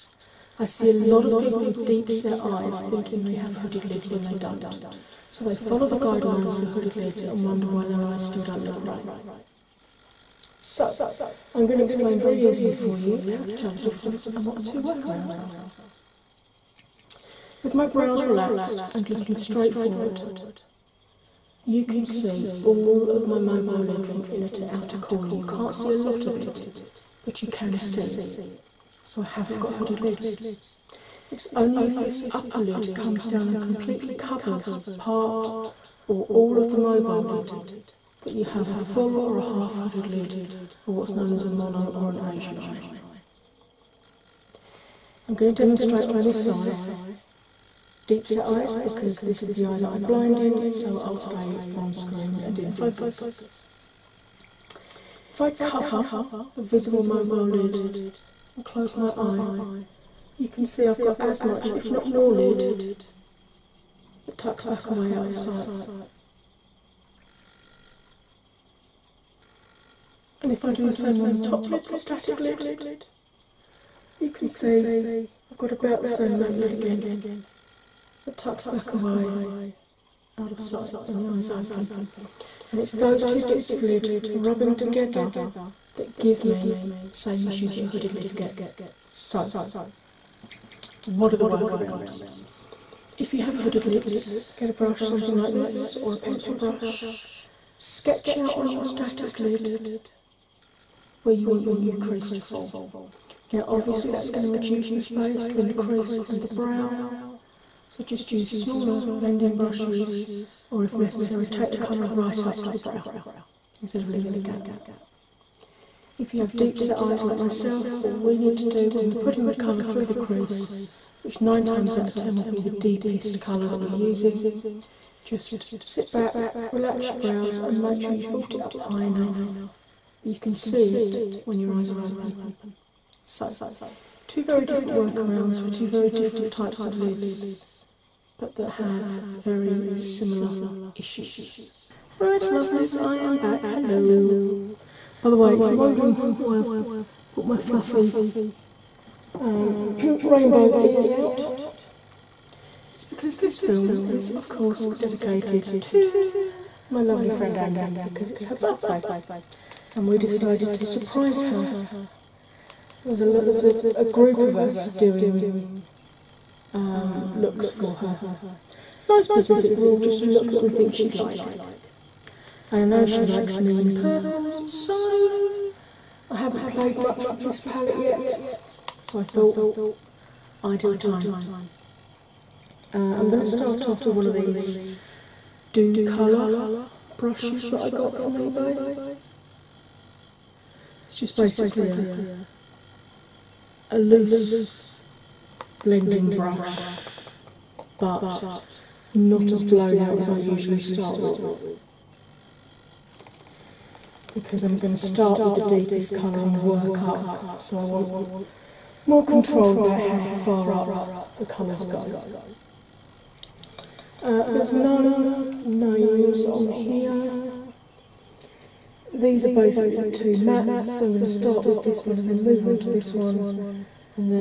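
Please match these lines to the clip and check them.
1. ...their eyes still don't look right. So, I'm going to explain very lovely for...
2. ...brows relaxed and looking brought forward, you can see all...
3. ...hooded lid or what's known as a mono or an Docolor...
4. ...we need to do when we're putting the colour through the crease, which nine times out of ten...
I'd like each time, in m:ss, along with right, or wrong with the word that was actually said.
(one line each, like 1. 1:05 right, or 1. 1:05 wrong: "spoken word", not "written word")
1. 0:07 wrong: "easily", not "lovely"
2. 0:17 wrong: "straight", not "brought"
3. 0:39 wrong: "Asian", not "Docolor"
4. 1:58 right.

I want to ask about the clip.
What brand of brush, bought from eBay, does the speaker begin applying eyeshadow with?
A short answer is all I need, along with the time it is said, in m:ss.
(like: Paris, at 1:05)
Docolor, at 3:05.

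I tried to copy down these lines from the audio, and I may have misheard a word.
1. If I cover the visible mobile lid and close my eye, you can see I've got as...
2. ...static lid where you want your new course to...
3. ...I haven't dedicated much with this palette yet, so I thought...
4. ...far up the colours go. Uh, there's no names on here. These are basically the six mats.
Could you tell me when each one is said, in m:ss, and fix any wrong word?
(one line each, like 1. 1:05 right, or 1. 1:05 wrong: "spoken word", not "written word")
1. 0:55 right
2. 1:38 wrong: "crease", not "course"
3. 2:56 wrong: "played", not "dedicated"
4. 3:30 wrong: "two", not "six".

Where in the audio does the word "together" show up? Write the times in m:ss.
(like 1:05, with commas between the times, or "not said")
1:24.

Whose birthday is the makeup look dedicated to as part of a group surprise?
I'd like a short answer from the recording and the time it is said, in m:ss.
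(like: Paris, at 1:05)
Anya, at 2:37.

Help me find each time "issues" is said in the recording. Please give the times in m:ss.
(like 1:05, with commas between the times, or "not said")
1:27, 2:20.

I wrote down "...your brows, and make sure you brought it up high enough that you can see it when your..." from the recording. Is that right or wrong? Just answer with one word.
right.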